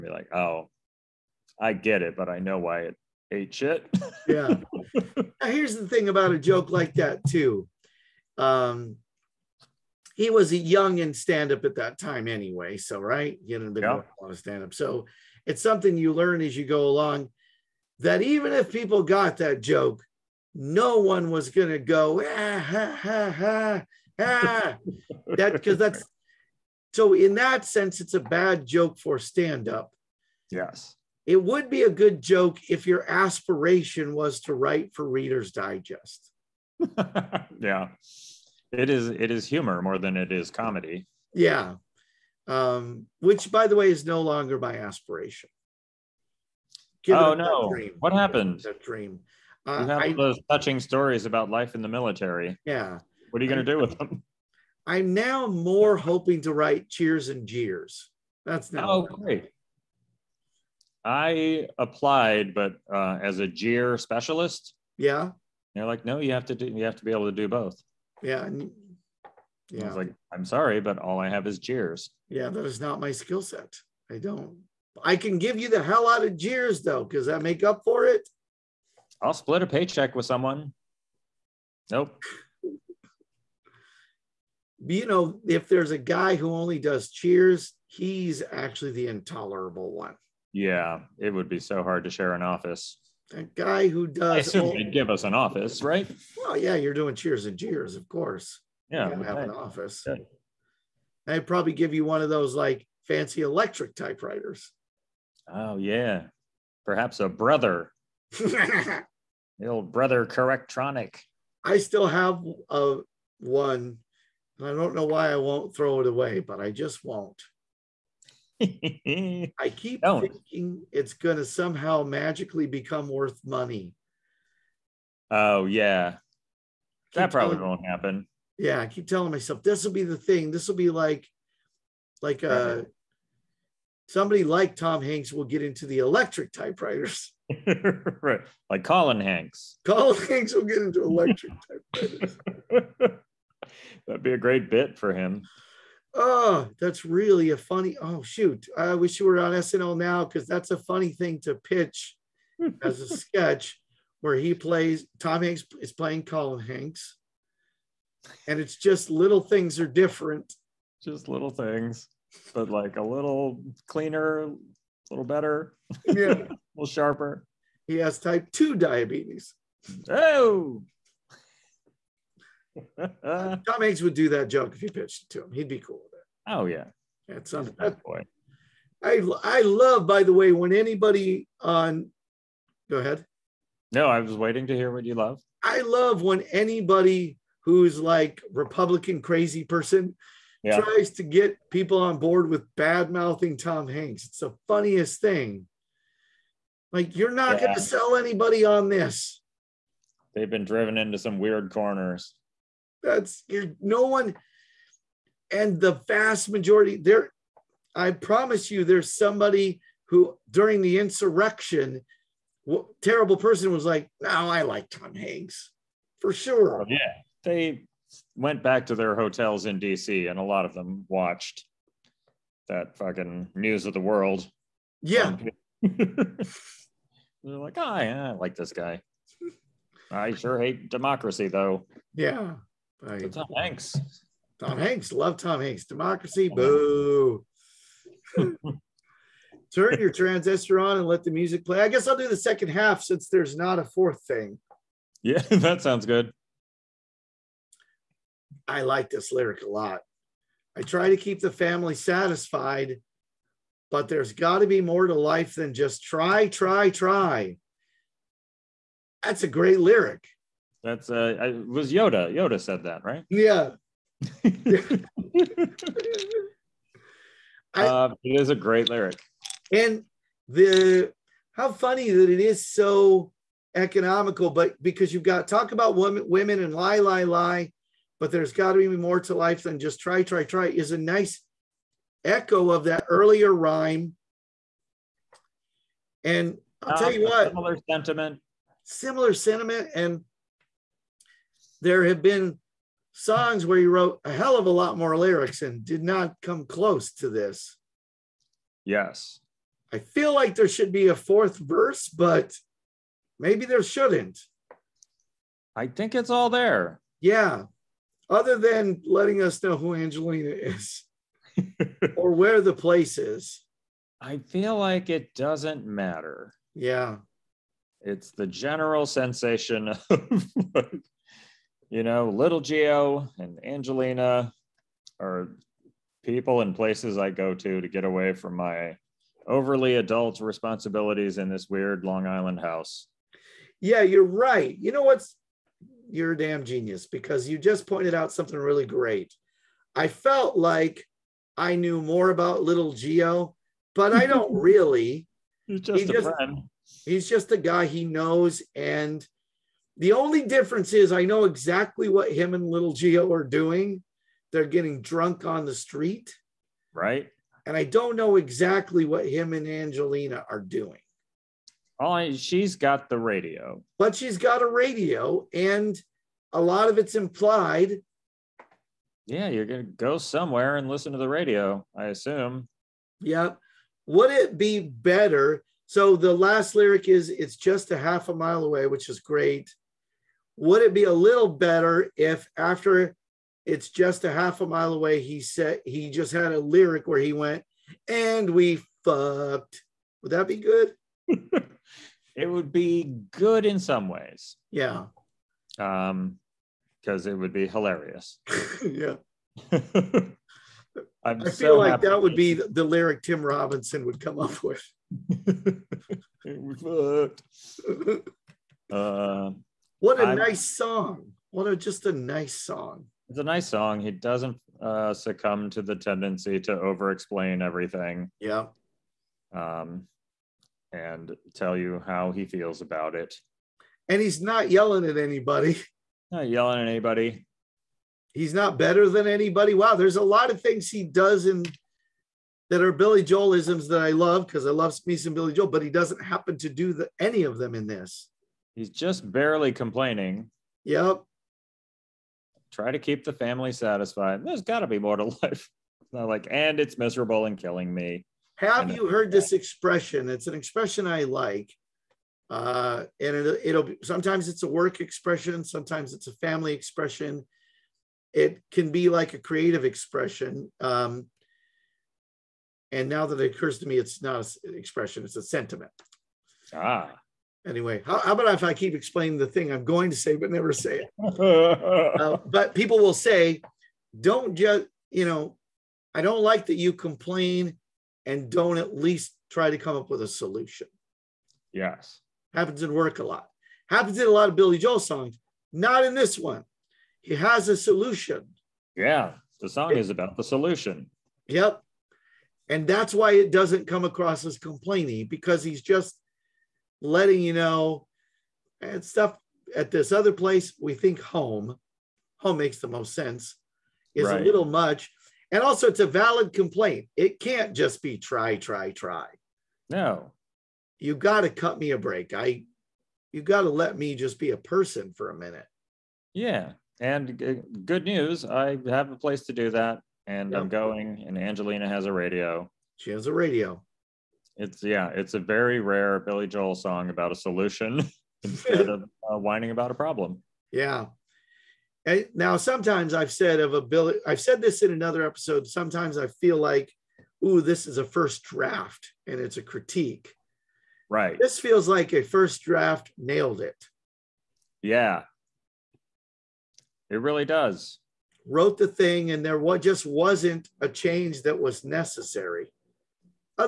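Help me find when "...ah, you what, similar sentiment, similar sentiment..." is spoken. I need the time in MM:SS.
04:47.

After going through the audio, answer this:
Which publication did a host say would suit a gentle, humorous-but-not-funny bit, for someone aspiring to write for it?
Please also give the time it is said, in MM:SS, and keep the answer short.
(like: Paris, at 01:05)
Reader's Digest, at 00:35.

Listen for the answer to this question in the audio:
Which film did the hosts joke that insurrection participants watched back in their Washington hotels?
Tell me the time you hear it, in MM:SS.
03:43.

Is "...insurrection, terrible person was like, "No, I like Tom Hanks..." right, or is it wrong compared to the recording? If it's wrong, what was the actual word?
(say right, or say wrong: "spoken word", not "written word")
right.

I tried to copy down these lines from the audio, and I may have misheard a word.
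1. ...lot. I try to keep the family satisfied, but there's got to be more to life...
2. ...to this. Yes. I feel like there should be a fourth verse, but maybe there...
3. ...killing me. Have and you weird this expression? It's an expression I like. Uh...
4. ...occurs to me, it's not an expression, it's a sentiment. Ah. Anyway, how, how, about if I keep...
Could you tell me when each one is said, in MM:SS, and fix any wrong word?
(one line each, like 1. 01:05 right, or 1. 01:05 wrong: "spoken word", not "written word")
1. 04:09 right
2. 04:57 right
3. 07:27 wrong: "heard", not "weird"
4. 07:43 right.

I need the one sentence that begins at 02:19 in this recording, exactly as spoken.
Colin Hanks will get into electric typewriters.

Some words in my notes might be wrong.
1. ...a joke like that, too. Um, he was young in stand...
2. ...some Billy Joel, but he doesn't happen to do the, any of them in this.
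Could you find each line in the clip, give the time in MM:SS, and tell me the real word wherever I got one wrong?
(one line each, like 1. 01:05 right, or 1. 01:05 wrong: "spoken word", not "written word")
1. 00:06 right
2. 07:15 right.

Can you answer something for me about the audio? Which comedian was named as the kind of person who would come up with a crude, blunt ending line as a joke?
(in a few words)
Tim Robinson.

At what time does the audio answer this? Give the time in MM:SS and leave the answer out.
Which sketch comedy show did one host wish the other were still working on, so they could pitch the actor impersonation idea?
02:29.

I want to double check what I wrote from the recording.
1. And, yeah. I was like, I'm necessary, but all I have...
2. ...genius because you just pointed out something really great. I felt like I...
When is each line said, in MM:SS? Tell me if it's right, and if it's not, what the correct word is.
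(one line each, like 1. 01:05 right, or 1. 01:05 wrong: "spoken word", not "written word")
1. 01:08 wrong: "sorry", not "necessary"
2. 05:36 right.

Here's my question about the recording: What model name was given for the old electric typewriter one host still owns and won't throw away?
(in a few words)
Brother Correctronic.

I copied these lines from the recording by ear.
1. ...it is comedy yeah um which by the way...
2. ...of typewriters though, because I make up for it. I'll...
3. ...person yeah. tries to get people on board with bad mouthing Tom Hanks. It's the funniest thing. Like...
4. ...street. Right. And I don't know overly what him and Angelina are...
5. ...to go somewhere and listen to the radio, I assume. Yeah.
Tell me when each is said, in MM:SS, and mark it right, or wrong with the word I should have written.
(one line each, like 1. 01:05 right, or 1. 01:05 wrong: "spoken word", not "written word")
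1. 00:40 right
2. 01:16 wrong: "jeers", not "typewriters"
3. 03:09 right
4. 05:55 wrong: "exactly", not "overly"
5. 06:09 right.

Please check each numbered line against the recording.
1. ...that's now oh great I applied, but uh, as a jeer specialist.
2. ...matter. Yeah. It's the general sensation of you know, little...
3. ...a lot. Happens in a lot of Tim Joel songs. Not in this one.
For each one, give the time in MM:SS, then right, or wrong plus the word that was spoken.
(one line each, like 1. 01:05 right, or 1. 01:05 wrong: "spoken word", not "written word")
1. 00:58 right
2. 05:15 right
3. 08:03 wrong: "Billy", not "Tim".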